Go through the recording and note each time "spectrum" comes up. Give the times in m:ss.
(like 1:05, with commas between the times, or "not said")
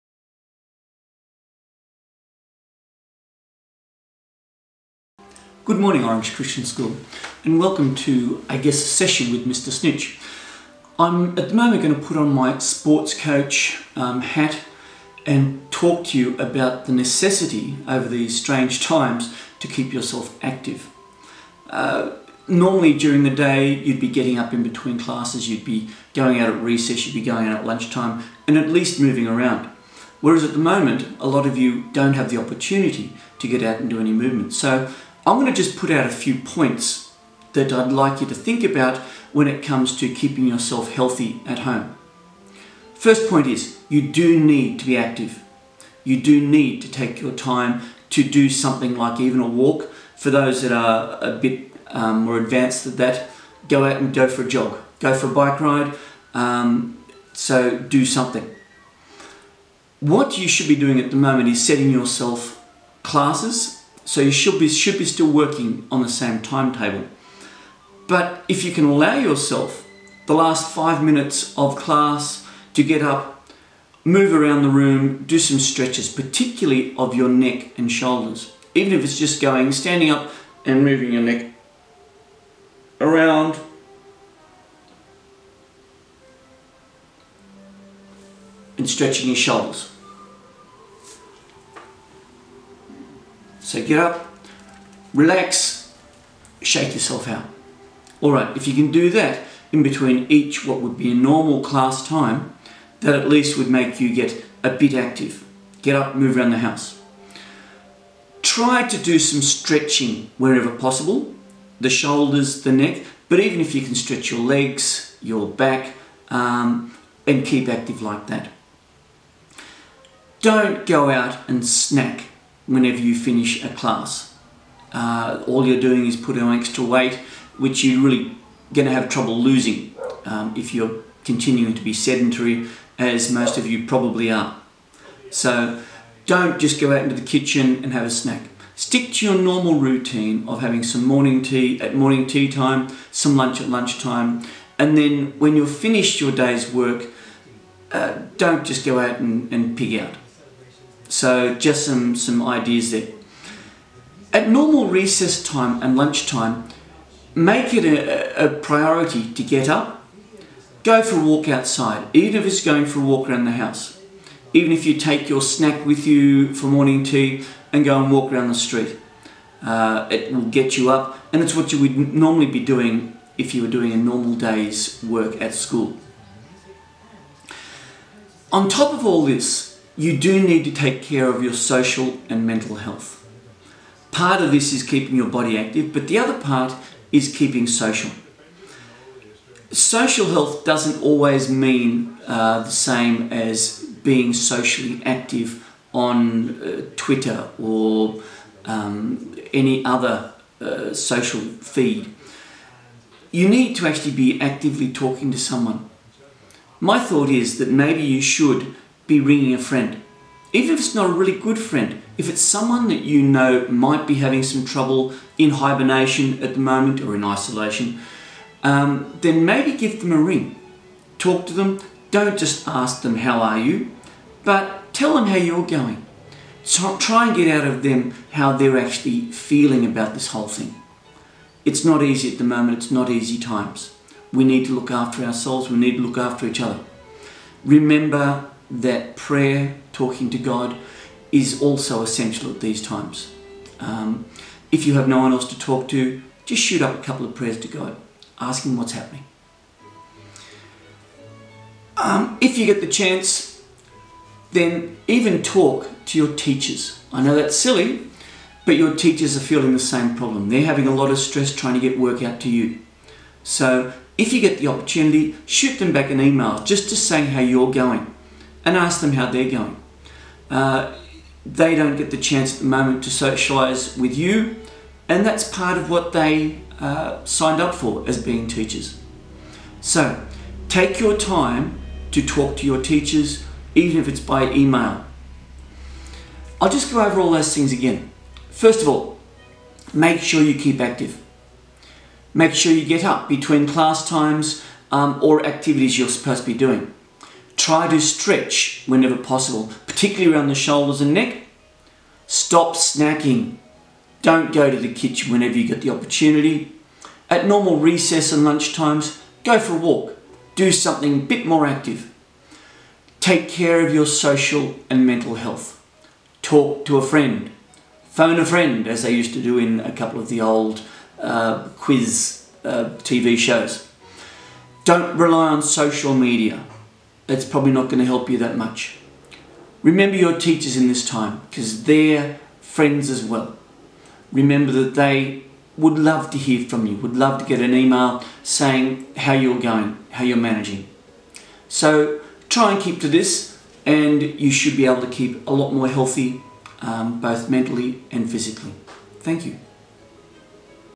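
not said.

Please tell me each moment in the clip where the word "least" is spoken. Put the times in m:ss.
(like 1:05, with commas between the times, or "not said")
0:28, 1:43.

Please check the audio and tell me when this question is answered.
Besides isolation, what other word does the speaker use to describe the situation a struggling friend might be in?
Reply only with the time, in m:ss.
3:35.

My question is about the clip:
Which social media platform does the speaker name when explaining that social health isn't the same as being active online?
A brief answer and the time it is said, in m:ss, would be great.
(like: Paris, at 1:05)
Twitter, at 3:16.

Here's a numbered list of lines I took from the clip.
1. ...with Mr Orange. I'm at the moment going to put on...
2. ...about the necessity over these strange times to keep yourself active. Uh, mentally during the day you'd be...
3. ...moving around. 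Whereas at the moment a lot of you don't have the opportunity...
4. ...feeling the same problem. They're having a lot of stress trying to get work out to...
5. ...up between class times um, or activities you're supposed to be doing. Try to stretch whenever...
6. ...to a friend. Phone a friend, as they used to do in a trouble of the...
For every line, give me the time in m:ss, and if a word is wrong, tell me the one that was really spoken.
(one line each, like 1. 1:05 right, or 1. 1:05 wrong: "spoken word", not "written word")
1. 0:09 wrong: "Snitch", not "Orange"
2. 0:16 wrong: "normally", not "mentally"
3. 0:28 right
4. 4:19 right
5. 4:53 right
6. 5:16 wrong: "couple", not "trouble".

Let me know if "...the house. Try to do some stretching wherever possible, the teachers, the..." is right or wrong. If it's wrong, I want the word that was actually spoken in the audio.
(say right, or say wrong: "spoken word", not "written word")
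wrong: "shoulders", not "teachers".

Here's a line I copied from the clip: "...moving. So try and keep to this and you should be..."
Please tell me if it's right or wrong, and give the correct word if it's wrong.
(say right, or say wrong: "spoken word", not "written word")
wrong: "managing", not "moving".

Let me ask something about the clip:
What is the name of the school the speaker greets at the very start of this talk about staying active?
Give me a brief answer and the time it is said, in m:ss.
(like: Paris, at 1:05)
Orange Christian School, at 0:06.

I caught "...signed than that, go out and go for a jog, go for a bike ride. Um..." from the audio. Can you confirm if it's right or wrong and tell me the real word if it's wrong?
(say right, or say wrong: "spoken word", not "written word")
wrong: "advanced", not "signed".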